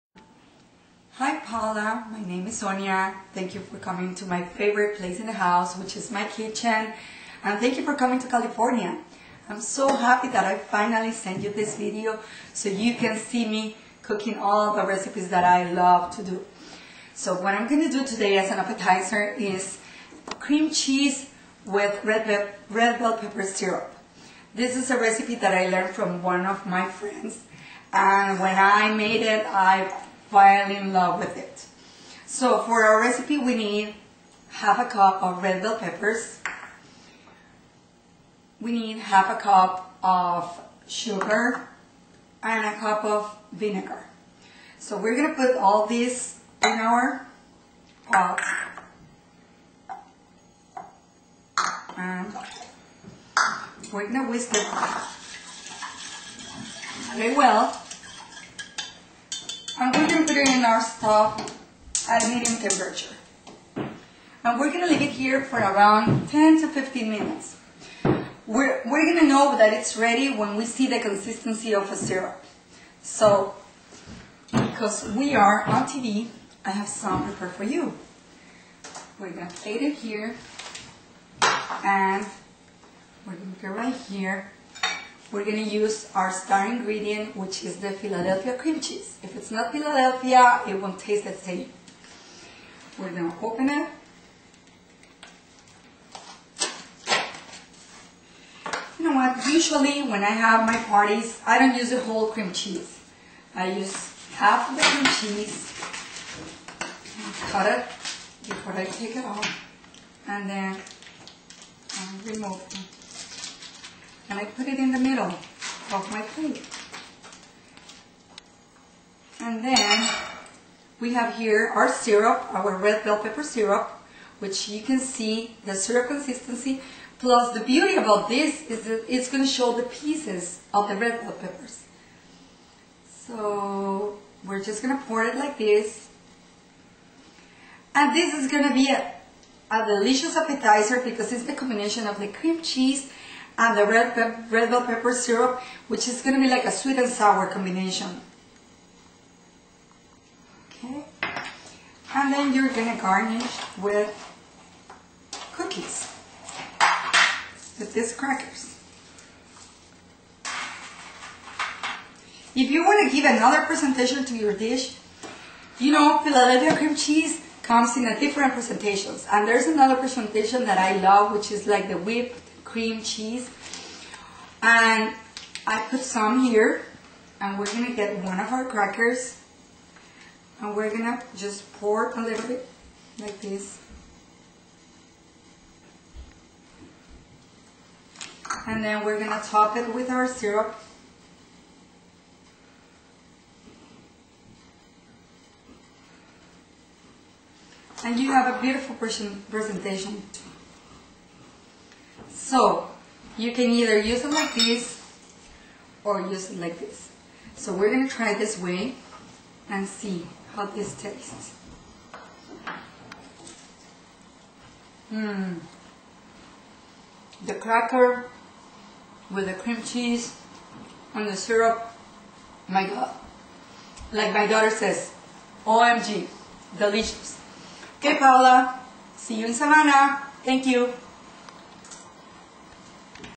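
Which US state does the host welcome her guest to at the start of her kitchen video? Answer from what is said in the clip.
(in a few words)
California.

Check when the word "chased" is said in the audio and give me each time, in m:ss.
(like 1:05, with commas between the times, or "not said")
not said.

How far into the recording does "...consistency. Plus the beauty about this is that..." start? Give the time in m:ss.
2:06.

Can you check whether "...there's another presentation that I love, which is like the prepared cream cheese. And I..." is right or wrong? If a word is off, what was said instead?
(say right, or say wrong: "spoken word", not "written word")
wrong: "whipped", not "prepared".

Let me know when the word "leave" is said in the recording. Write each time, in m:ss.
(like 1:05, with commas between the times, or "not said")
1:04.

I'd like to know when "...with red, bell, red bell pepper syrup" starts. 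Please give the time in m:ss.
0:21.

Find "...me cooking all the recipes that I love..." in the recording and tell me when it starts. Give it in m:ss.
0:13.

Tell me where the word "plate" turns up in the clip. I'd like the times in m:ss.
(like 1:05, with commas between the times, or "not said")
1:19, 1:56.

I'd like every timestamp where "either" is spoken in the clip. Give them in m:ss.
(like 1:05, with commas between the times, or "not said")
3:23.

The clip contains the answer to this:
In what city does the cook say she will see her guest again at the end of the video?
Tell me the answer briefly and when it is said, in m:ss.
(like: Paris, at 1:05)
Savannah, at 3:49.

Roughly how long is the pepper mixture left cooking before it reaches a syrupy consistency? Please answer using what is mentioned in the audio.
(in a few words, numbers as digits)
10 to 15 minutes.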